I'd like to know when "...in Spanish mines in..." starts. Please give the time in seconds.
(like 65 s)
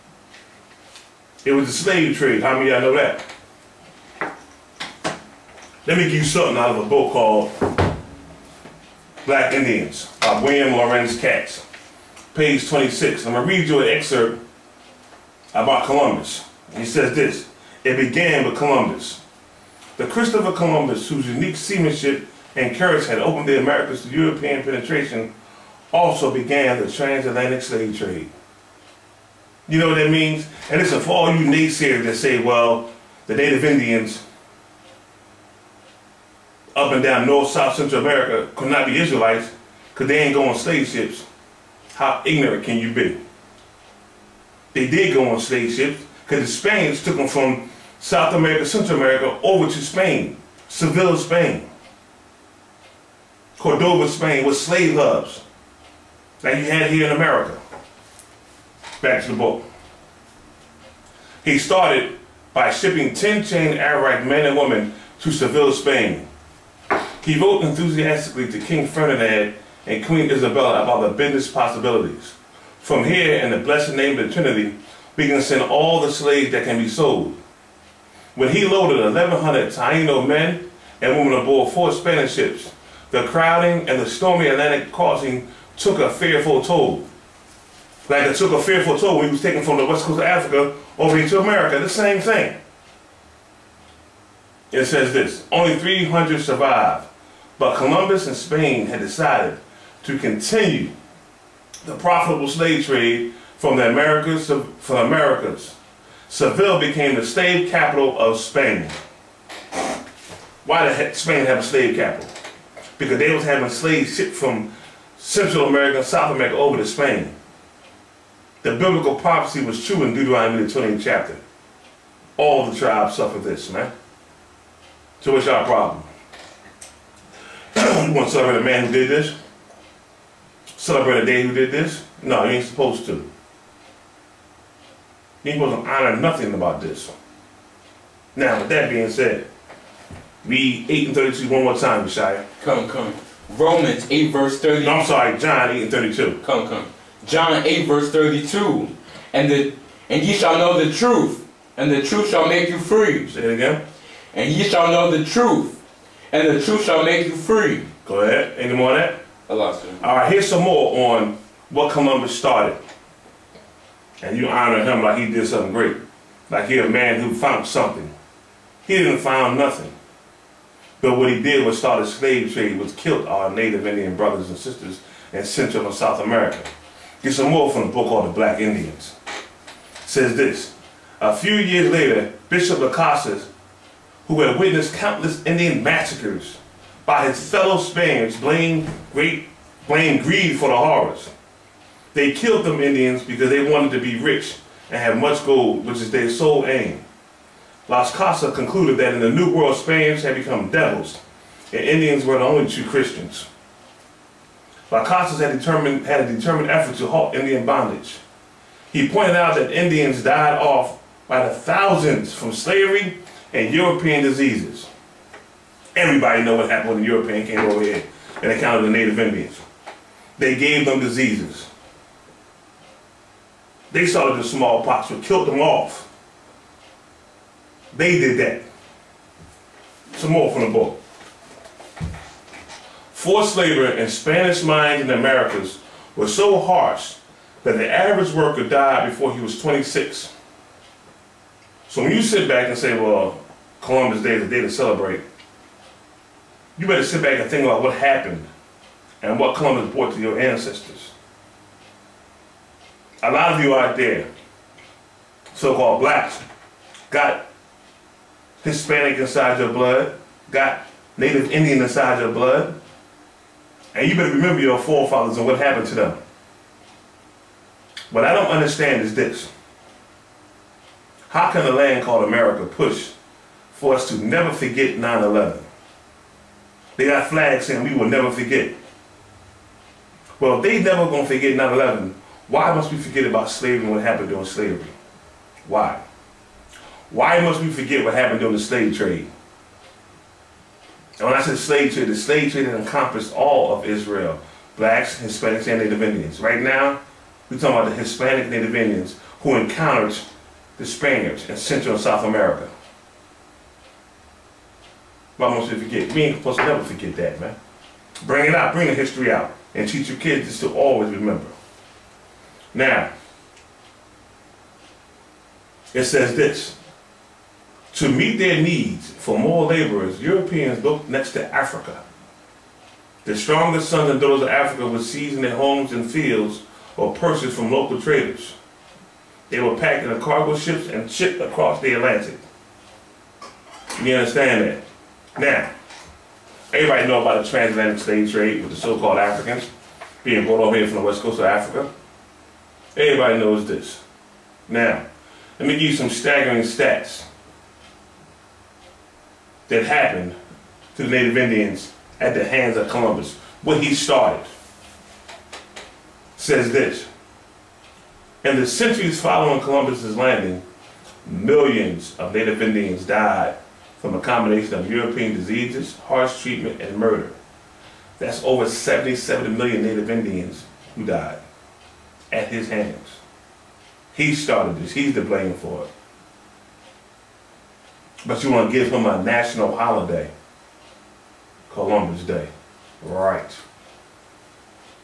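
233 s.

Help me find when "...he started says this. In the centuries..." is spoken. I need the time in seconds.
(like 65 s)
353 s.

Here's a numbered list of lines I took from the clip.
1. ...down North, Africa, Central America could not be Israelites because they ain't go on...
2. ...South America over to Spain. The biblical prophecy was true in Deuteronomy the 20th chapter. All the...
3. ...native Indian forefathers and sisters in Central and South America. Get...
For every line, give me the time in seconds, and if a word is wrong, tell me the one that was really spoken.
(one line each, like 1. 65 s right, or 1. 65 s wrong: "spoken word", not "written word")
1. 37 s wrong: "South", not "Africa"
2. 116 s right
3. 173 s wrong: "brothers", not "forefathers".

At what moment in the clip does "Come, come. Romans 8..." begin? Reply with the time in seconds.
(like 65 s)
142 s.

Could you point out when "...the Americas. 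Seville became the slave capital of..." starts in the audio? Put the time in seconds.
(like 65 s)
104 s.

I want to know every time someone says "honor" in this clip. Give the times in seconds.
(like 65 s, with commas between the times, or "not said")
135 s, 164 s.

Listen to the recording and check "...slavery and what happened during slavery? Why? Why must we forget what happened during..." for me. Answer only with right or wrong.
right.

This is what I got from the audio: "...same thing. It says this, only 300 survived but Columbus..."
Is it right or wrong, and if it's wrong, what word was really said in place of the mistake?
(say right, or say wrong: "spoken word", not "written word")
right.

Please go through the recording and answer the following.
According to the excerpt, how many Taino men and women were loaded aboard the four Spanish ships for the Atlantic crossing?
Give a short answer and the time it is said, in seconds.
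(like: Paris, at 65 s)
1,100, at 79 s.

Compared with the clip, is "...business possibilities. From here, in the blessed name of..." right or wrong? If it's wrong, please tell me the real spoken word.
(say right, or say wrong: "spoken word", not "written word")
right.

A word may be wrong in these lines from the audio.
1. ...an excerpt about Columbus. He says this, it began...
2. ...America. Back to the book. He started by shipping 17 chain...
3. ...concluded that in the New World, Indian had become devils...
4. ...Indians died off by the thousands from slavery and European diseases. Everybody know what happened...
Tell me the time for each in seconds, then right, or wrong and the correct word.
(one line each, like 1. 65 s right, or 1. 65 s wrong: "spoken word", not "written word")
1. 13 s right
2. 57 s wrong: "10", not "17"
3. 198 s wrong: "Spaniards", not "Indian"
4. 209 s right.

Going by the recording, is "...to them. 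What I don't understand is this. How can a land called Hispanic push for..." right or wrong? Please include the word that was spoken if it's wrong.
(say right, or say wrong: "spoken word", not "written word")
wrong: "America", not "Hispanic".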